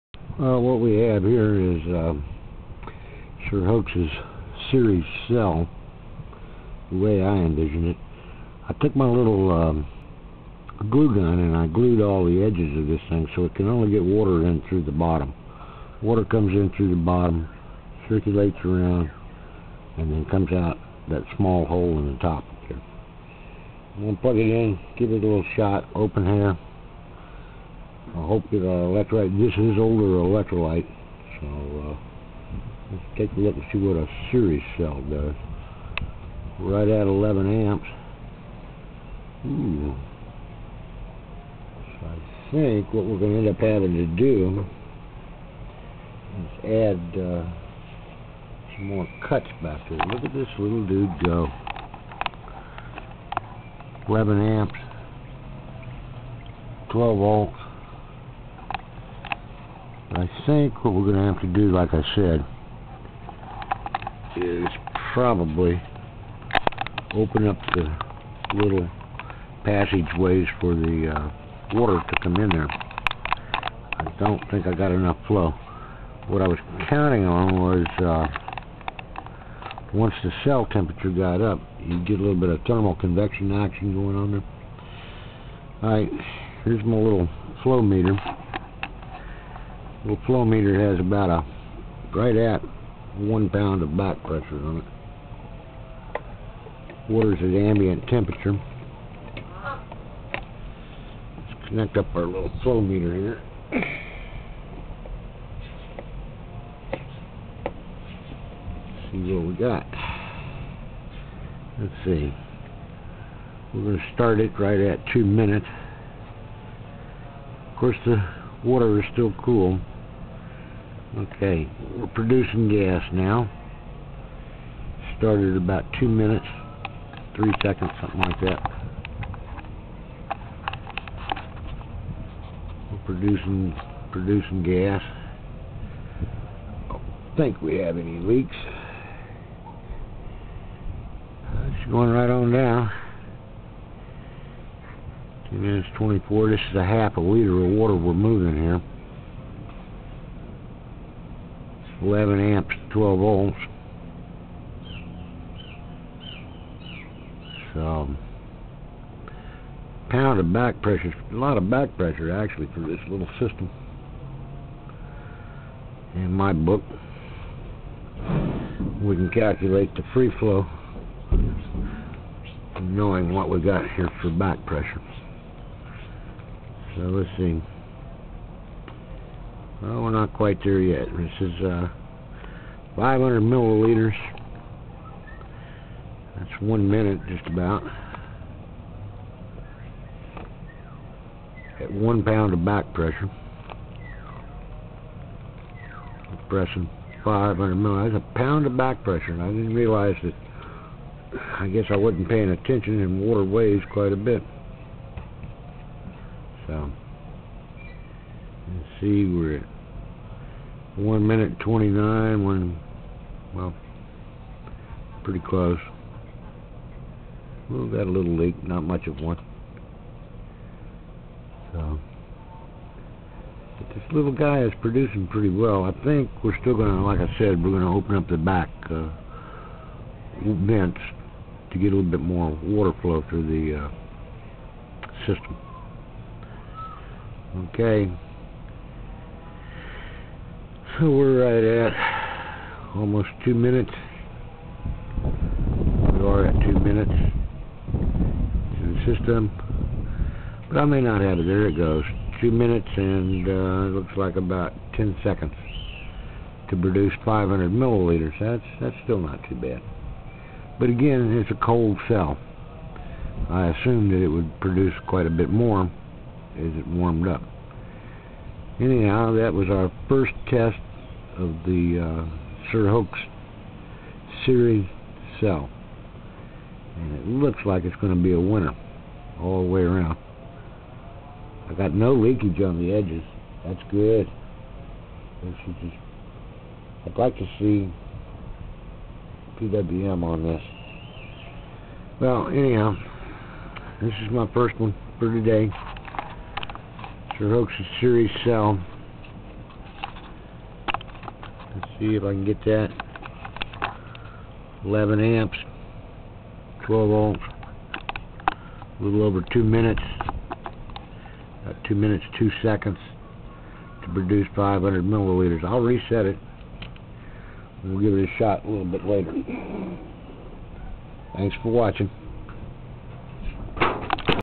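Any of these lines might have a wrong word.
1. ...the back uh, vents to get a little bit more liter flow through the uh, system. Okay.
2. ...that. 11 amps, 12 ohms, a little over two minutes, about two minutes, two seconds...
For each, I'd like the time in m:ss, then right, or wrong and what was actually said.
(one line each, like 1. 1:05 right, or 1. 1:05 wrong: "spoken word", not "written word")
1. 3:48 wrong: "water", not "liter"
2. 5:02 right.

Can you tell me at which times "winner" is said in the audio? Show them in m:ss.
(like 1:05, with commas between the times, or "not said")
4:38.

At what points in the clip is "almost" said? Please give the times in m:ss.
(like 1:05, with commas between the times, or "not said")
4:02.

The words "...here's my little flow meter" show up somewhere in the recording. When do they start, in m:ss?
1:26.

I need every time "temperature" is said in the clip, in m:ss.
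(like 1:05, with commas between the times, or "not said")
1:20, 1:38.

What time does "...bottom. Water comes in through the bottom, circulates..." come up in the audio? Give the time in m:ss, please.
0:14.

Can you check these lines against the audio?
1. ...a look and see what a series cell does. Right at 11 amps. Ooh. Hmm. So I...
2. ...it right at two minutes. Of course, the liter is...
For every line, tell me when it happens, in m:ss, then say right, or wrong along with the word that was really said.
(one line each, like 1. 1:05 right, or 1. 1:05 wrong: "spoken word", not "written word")
1. 0:33 right
2. 1:54 wrong: "water", not "liter".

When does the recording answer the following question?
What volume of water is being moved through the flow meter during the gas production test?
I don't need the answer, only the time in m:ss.
2:26.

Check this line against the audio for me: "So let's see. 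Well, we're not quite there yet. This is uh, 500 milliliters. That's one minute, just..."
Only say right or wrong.
right.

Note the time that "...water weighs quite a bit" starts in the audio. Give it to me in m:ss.
3:23.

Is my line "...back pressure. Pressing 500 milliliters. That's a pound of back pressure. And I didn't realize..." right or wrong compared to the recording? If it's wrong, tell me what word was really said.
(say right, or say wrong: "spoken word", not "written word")
right.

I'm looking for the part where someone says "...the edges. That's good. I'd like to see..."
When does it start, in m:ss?
4:42.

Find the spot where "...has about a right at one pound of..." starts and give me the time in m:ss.
1:30.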